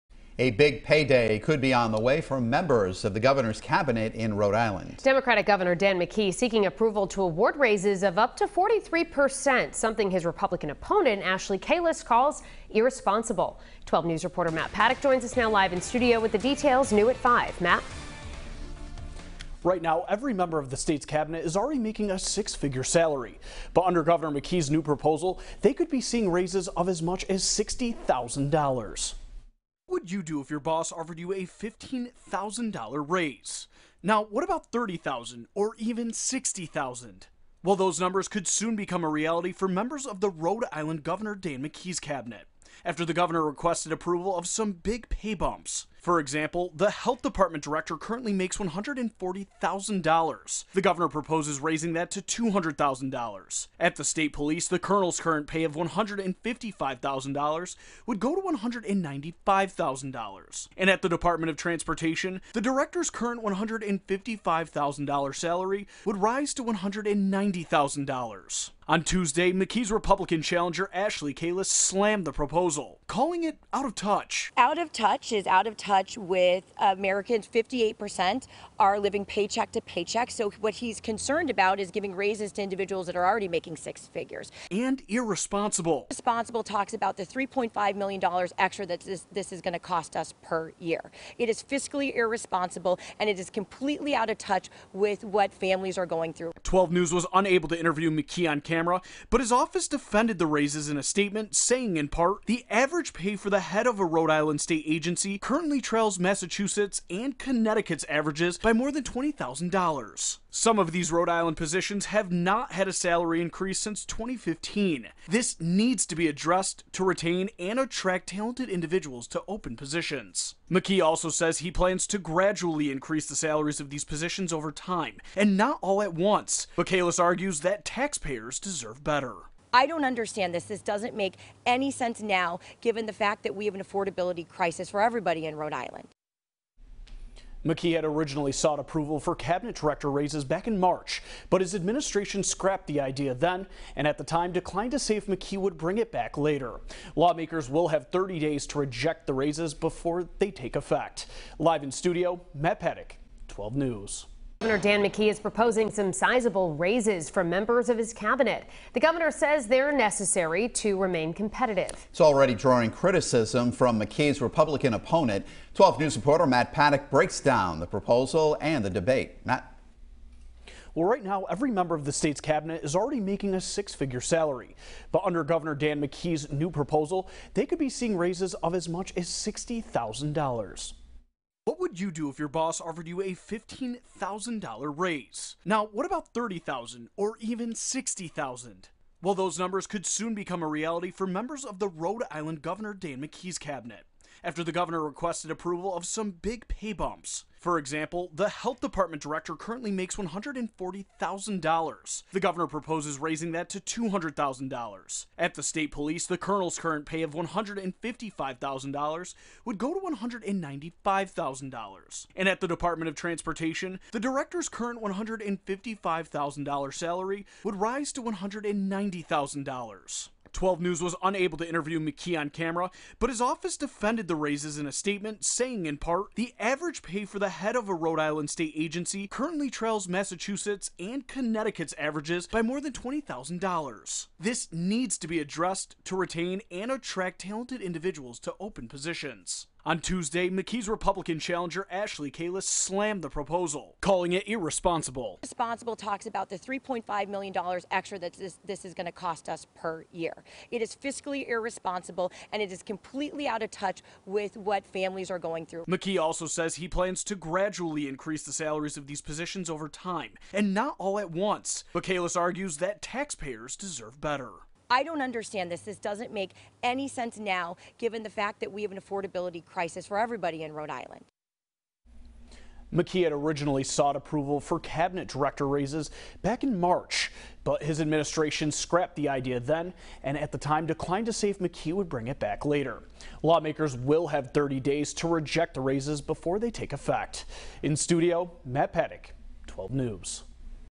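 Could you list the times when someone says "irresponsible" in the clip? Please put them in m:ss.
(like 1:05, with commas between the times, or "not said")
0:12, 1:25, 1:32, 4:04, 4:11.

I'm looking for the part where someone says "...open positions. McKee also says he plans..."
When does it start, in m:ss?
1:59.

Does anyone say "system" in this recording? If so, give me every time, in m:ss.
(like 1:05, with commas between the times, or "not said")
not said.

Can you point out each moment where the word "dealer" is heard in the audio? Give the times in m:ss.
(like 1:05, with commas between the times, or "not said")
not said.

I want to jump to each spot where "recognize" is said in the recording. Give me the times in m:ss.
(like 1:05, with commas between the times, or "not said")
not said.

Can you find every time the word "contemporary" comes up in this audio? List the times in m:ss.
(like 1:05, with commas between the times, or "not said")
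not said.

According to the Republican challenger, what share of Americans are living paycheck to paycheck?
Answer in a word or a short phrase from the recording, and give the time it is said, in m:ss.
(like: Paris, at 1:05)
58%, at 1:17.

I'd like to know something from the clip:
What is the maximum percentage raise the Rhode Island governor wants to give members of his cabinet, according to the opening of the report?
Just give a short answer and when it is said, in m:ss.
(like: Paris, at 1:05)
43%, at 0:08.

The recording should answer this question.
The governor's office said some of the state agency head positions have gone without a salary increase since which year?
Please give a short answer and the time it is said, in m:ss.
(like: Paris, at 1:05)
2015, at 1:54.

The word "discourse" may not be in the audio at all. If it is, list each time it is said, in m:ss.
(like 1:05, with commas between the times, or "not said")
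not said.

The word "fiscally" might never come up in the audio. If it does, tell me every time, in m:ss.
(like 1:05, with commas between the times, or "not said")
1:31, 4:10.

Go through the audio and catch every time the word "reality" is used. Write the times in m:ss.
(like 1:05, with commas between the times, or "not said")
0:39, 3:10.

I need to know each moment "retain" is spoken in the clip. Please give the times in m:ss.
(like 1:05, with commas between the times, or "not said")
1:57, 3:56.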